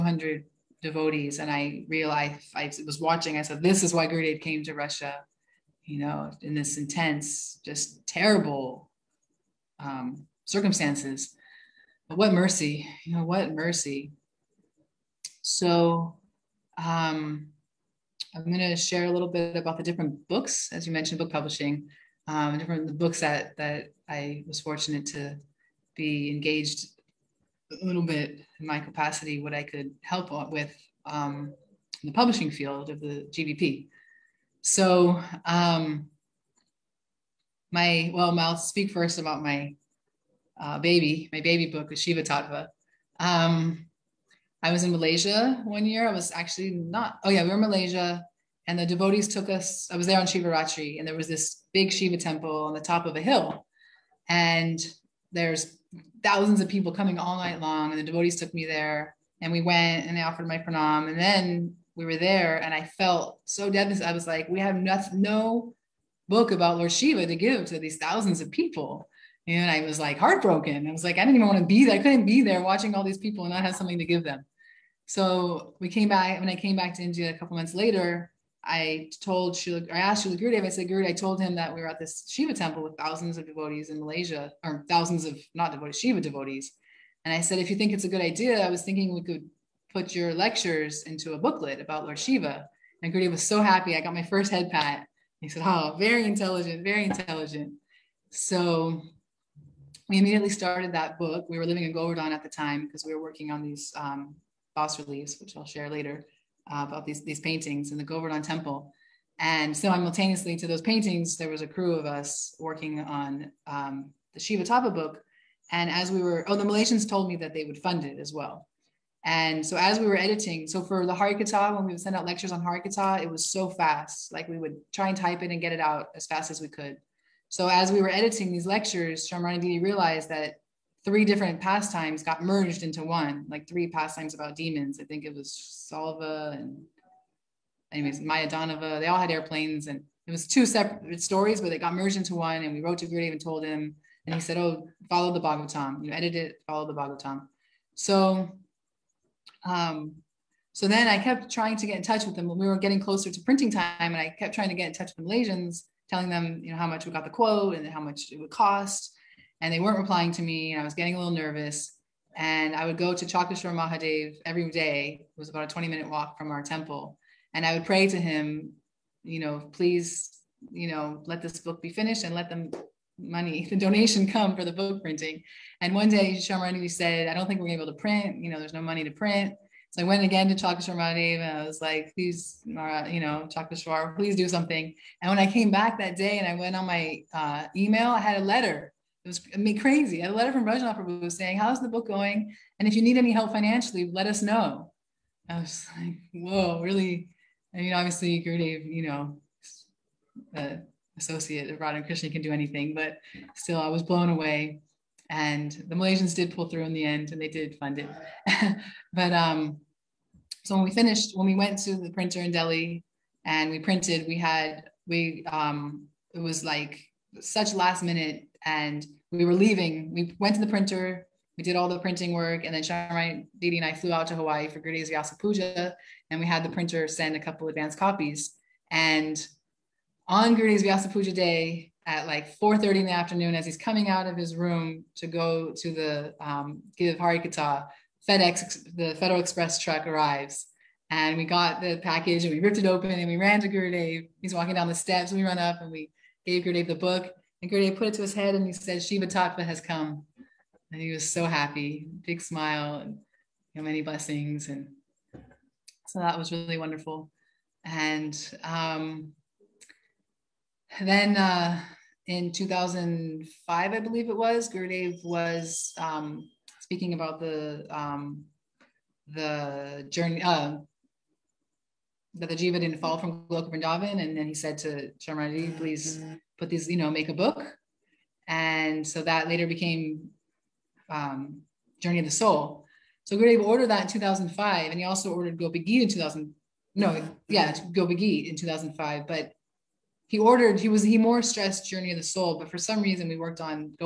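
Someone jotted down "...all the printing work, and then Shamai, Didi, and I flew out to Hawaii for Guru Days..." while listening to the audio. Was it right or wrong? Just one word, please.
right.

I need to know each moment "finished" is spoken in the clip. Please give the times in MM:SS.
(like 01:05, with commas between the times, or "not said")
02:51, 03:30.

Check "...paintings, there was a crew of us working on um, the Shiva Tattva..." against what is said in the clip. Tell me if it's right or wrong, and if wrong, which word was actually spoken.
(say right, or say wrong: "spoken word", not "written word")
right.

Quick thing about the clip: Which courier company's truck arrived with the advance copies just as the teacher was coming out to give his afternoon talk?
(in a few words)
FedEx.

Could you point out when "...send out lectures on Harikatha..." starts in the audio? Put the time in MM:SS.
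02:01.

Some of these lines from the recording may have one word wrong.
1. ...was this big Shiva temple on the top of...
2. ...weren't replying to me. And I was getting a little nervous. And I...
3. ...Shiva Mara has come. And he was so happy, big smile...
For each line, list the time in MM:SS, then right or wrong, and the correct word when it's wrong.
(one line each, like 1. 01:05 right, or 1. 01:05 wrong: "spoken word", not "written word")
1. 00:51 right
2. 02:39 right
3. 04:09 wrong: "Tattva", not "Mara".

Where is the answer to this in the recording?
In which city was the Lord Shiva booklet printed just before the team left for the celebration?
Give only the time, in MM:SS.
03:32.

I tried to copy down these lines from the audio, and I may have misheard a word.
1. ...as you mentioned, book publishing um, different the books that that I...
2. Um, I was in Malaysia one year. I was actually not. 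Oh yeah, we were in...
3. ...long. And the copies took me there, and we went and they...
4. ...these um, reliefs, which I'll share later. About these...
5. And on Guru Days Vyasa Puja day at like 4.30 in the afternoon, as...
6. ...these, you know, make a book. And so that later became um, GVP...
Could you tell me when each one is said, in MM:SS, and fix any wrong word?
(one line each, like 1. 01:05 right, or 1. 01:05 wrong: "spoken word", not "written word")
1. 00:20 right
2. 00:43 right
3. 00:57 wrong: "devotees", not "copies"
4. 01:43 right
5. 03:48 right
6. 04:36 wrong: "Journey", not "GVP".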